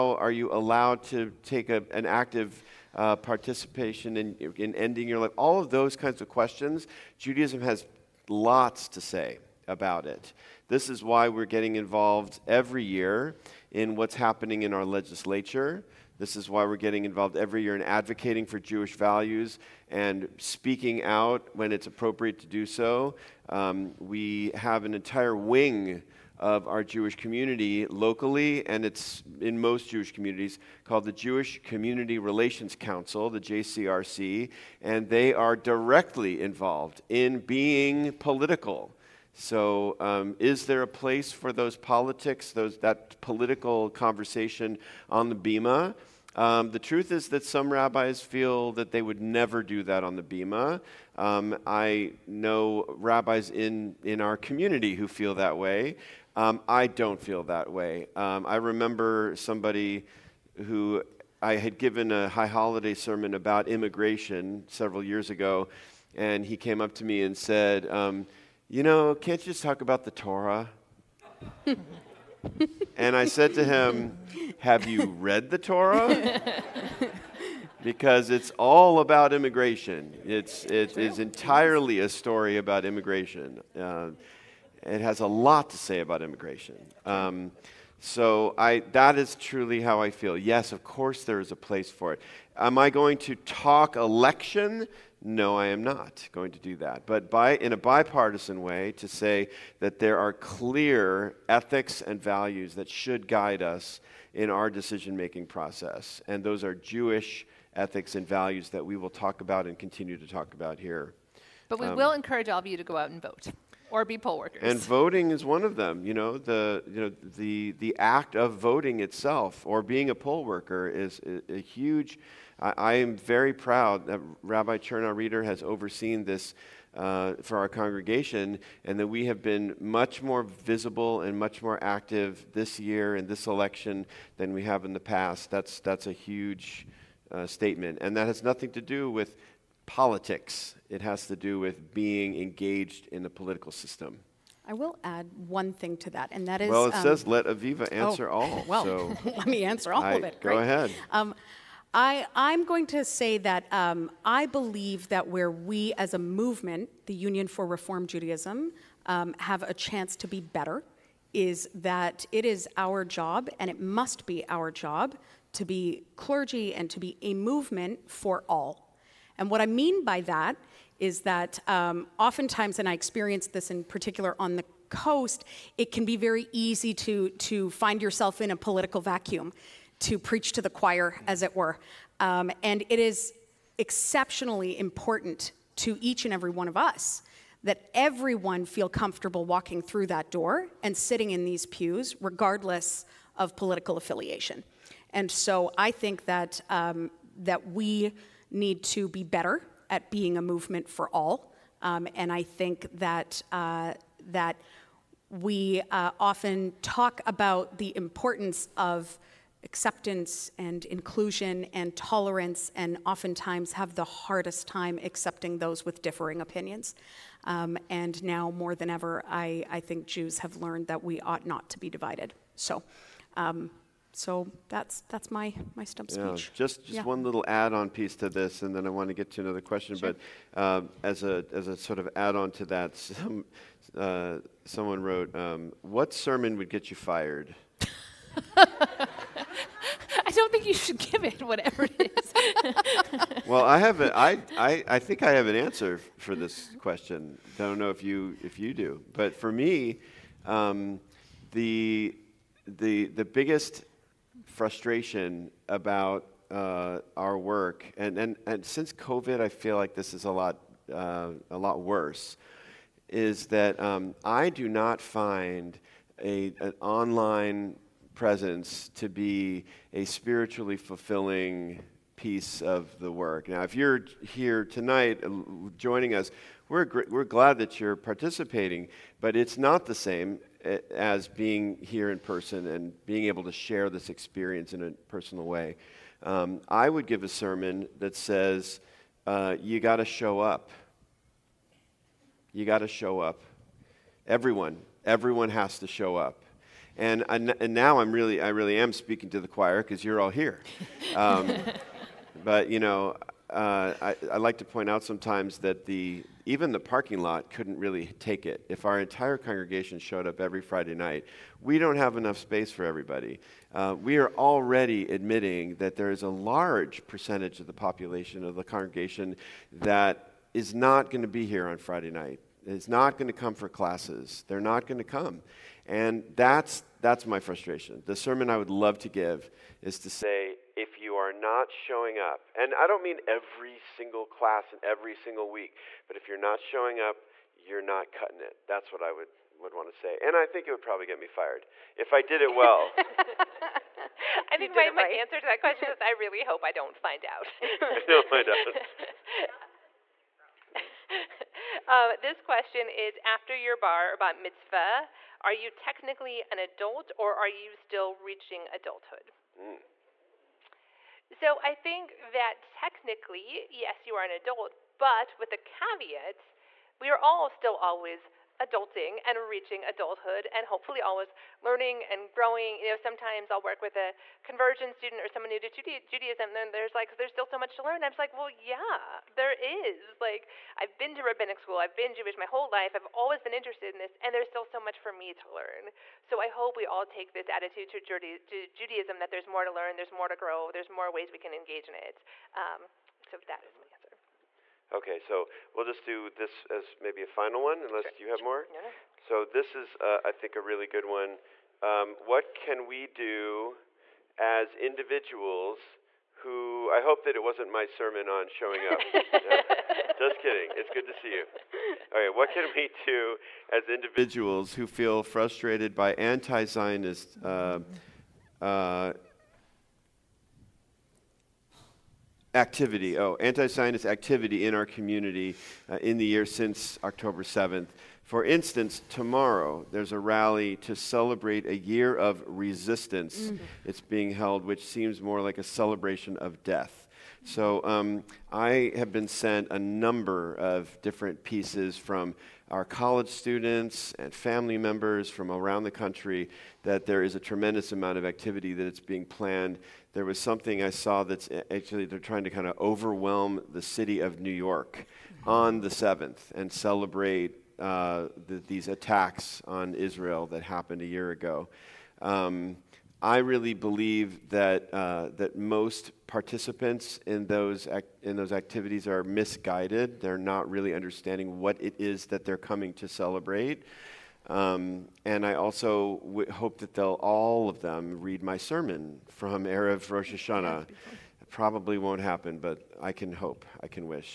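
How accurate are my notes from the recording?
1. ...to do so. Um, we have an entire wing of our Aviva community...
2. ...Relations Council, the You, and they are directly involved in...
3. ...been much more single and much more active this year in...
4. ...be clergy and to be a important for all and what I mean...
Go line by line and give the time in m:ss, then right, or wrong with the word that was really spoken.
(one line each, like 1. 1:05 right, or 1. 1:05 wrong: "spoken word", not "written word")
1. 0:22 wrong: "Jewish", not "Aviva"
2. 0:32 wrong: "JCRC", not "You"
3. 2:09 wrong: "visible", not "single"
4. 2:45 wrong: "movement", not "important".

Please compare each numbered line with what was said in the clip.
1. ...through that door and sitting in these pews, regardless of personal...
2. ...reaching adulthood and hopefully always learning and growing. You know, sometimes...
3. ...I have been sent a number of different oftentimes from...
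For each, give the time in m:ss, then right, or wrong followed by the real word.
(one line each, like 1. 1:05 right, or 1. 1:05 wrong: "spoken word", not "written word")
1. 3:09 wrong: "political", not "personal"
2. 6:09 right
3. 7:18 wrong: "pieces", not "oftentimes".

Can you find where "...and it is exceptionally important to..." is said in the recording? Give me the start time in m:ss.
3:02.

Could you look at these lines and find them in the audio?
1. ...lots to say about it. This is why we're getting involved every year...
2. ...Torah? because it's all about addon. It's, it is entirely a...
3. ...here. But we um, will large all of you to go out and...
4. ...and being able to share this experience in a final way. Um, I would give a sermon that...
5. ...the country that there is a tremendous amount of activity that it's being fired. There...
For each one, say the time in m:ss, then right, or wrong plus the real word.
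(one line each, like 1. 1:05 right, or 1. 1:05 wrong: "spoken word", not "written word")
1. 0:08 right
2. 1:15 wrong: "immigration", not "addon"
3. 1:50 wrong: "encourage", not "large"
4. 4:42 wrong: "personal", not "final"
5. 7:25 wrong: "planned", not "fired".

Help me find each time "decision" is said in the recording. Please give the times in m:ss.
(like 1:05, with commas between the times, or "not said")
1:44.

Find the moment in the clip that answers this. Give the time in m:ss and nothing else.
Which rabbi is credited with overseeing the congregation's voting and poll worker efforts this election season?
2:04.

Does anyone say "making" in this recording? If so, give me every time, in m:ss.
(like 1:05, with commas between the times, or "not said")
1:45.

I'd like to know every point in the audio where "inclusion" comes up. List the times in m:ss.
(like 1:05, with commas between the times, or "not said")
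3:30.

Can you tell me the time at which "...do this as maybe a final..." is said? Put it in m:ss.
6:36.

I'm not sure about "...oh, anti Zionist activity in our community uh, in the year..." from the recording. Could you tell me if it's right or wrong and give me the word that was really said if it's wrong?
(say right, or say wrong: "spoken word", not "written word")
right.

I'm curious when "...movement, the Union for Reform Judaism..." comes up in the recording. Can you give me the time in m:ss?
2:36.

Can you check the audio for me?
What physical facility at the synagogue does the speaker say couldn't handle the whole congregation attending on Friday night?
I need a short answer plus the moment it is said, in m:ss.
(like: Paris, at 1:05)
The parking lot, at 5:06.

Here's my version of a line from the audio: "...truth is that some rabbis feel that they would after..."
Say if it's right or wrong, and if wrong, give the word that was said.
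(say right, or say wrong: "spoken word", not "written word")
wrong: "never", not "after".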